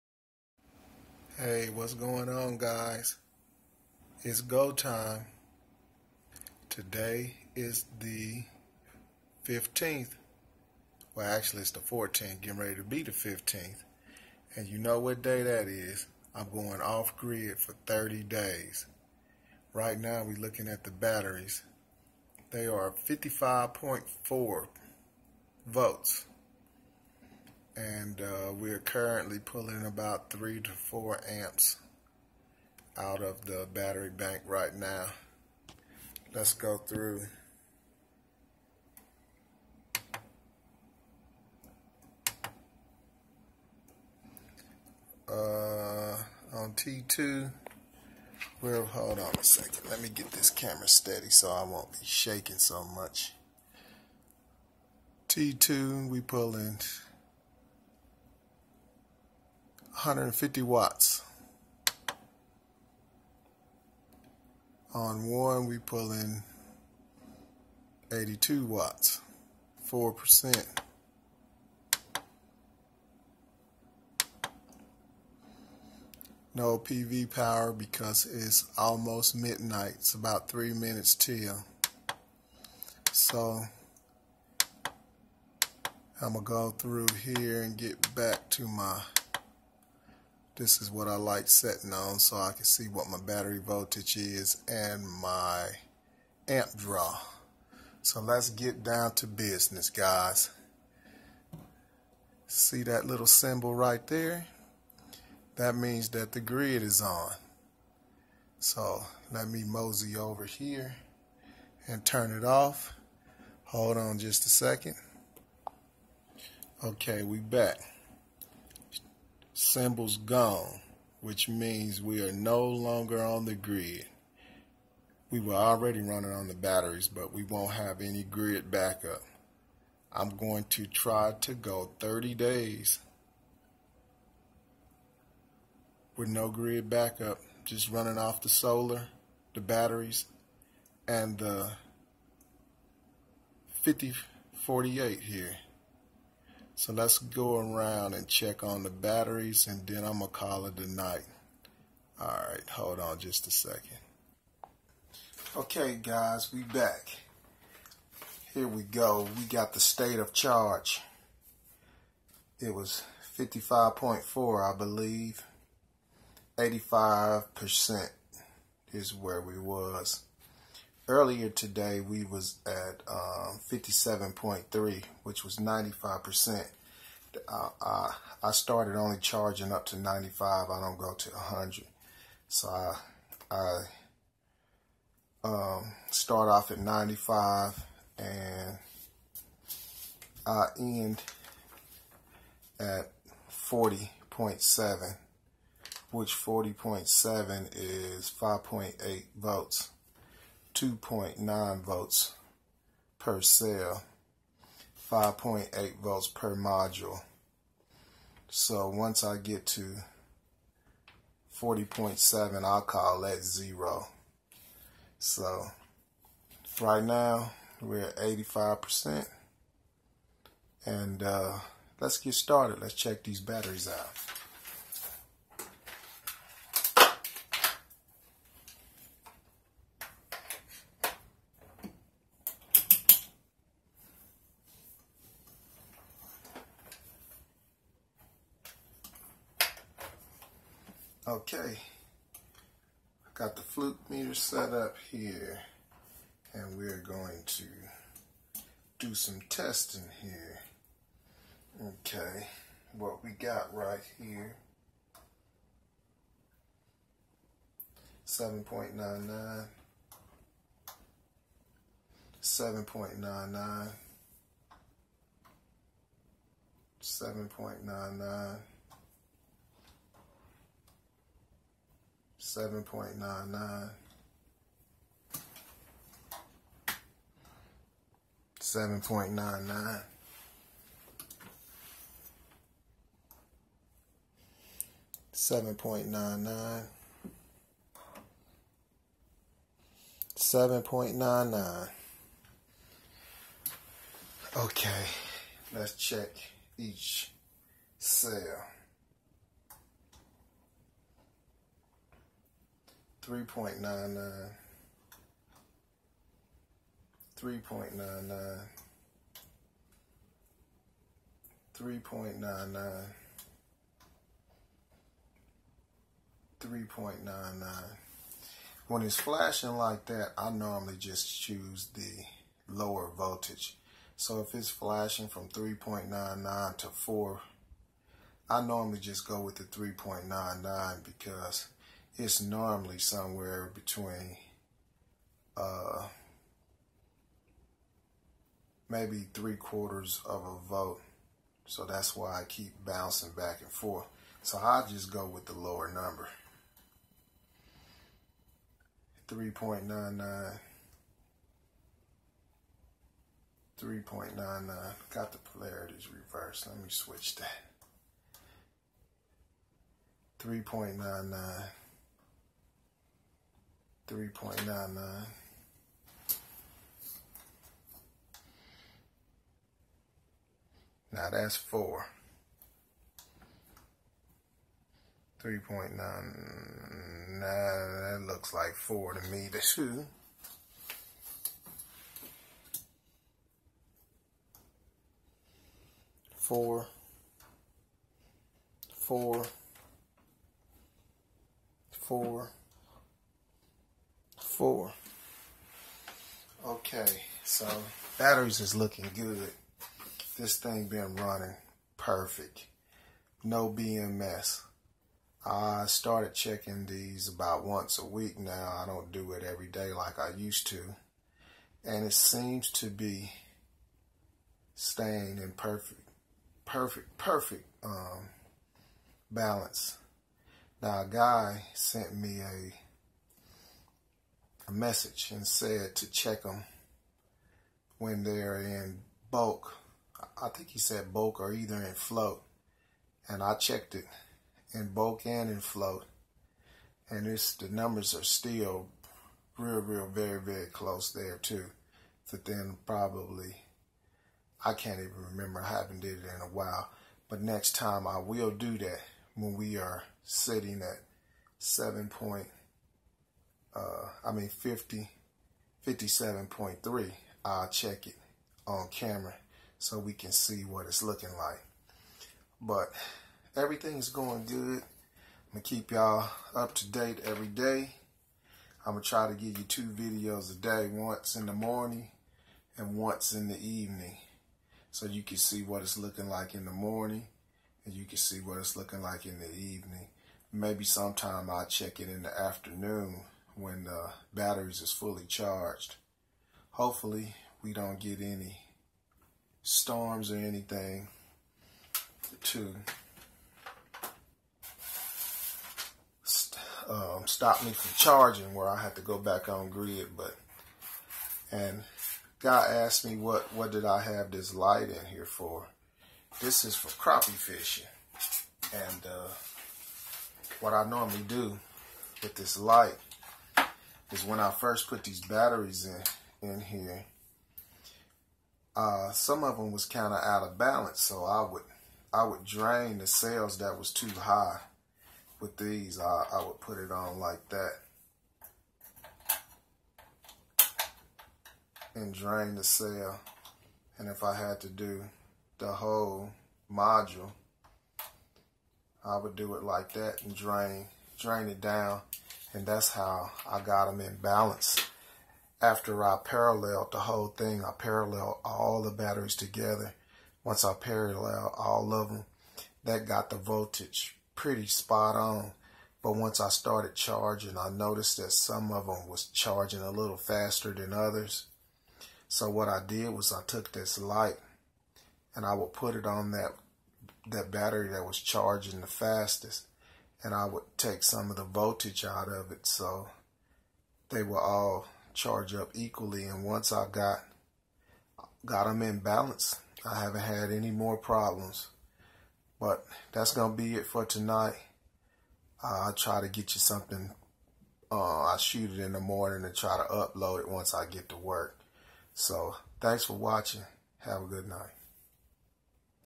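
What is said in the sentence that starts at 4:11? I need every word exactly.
Okay, what we got right here.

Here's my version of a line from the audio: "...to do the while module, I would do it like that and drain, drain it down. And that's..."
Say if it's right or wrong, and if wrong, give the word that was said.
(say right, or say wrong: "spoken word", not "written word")
wrong: "whole", not "while".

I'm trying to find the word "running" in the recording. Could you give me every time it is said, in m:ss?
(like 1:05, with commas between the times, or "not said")
2:06, 2:17, 6:41.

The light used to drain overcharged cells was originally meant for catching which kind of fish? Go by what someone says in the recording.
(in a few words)
crappie.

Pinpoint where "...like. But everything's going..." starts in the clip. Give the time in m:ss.
7:41.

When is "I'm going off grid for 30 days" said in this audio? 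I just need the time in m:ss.
0:16.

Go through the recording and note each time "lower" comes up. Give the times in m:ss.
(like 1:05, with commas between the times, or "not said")
5:22, 5:45.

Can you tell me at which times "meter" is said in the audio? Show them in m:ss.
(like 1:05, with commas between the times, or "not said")
4:04.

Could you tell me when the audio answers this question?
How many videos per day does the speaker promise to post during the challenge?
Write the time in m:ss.
7:49.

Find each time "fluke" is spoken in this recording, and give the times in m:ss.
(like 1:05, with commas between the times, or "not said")
4:03.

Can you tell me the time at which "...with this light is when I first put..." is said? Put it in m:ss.
8:32.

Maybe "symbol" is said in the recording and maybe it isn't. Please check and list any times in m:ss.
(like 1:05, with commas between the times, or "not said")
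1:43, 1:59.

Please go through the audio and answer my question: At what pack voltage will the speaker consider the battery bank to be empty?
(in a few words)
40.7.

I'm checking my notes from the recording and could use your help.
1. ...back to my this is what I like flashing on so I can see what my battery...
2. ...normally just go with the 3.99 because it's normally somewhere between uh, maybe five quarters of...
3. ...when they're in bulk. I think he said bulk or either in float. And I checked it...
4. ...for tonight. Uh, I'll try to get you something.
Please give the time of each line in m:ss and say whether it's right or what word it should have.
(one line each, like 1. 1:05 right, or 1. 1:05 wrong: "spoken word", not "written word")
1. 1:28 wrong: "setting", not "flashing"
2. 5:28 wrong: "three", not "five"
3. 7:07 right
4. 9:43 right.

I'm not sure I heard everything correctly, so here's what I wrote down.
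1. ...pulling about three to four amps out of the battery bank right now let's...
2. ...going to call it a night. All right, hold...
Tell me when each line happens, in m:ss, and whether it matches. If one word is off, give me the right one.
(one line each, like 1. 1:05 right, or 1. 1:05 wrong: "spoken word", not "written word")
1. 0:29 right
2. 2:30 right.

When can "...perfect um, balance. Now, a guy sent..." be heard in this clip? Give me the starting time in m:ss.
6:57.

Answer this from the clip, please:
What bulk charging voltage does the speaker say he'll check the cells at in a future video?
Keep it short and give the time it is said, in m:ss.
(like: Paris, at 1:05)
57.3, at 7:35.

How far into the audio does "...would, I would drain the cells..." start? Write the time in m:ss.
8:41.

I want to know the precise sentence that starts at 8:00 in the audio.
Maybe sometime I'll check it in the afternoon when the batteries is fully charged.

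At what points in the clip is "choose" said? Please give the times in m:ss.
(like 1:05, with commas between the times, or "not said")
5:21.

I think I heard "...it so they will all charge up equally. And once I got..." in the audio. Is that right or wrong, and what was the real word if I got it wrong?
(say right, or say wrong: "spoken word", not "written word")
right.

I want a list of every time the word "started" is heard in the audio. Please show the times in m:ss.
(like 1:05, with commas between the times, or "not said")
3:42, 6:45, 9:16.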